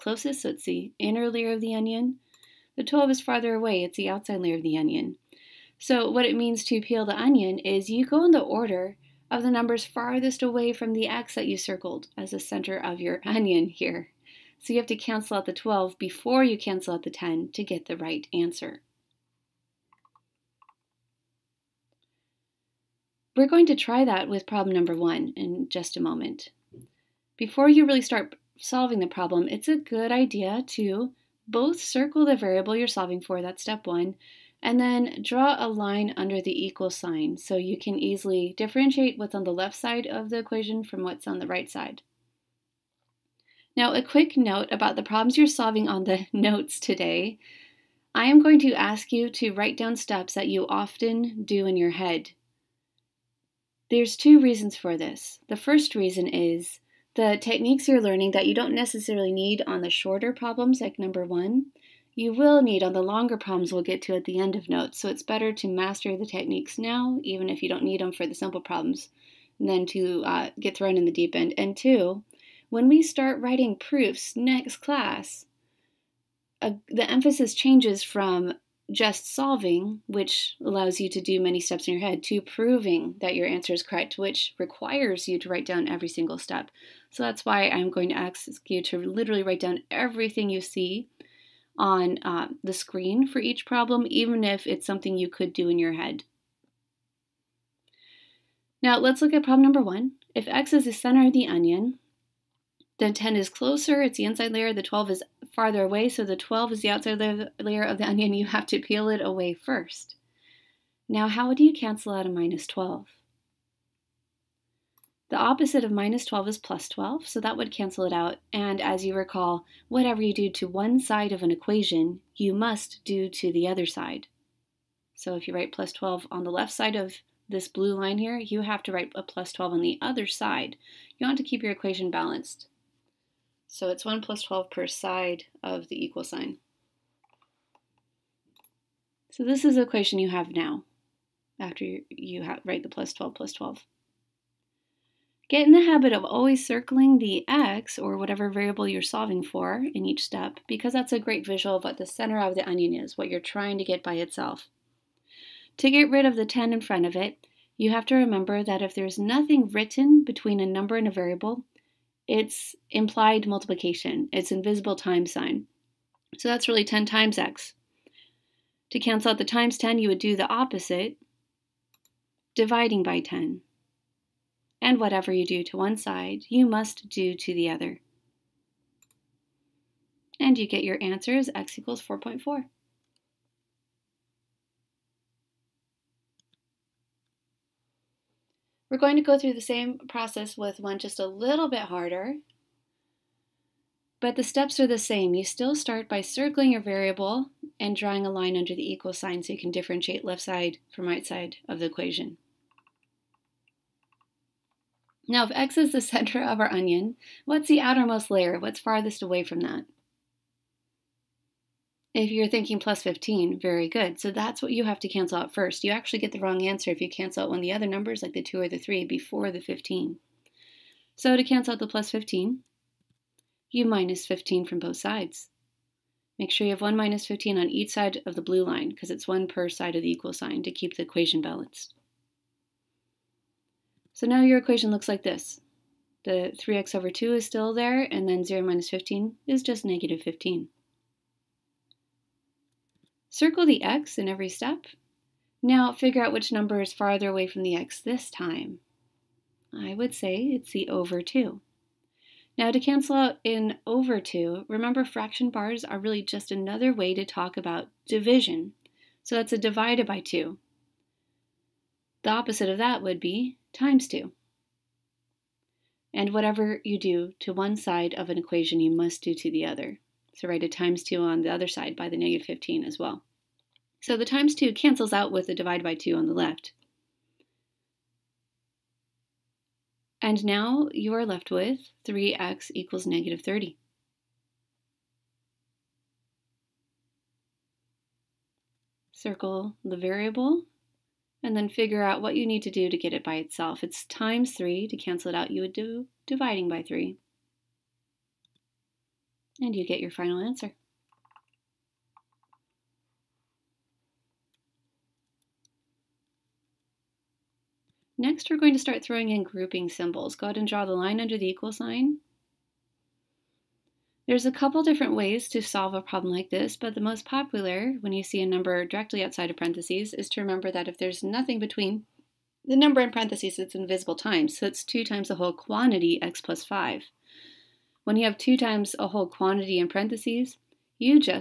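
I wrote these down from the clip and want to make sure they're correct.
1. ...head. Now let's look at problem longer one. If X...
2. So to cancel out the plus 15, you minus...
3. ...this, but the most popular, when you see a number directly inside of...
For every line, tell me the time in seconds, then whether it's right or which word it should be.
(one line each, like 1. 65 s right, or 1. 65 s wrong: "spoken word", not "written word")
1. 95 s wrong: "number", not "longer"
2. 221 s right
3. 316 s wrong: "outside", not "inside".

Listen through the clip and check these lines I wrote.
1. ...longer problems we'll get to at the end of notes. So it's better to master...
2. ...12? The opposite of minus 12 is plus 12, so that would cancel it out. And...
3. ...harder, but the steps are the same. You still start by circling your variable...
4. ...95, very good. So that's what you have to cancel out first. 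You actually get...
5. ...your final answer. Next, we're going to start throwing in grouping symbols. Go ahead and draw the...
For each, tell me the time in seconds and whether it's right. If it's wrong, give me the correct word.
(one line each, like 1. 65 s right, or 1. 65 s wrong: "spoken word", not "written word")
1. 63 s right
2. 112 s right
3. 191 s right
4. 213 s wrong: "15", not "95"
5. 300 s right.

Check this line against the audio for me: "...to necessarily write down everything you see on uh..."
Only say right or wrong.
wrong.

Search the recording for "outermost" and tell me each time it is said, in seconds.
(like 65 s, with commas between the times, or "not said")
207 s.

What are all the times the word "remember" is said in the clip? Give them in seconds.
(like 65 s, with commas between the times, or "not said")
158 s, 254 s, 320 s.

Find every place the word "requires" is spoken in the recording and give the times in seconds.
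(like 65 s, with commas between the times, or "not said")
84 s.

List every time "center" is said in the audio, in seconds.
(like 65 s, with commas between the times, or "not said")
12 s, 100 s, 152 s, 206 s.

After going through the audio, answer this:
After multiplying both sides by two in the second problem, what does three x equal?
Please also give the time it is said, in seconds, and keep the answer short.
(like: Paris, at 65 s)
negative 30, at 283 s.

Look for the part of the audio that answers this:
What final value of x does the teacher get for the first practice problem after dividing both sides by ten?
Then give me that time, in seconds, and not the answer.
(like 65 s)
181 s.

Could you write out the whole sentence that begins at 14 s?
So, you have to cancel out the 12 before you cancel out the 10 to get the right answer.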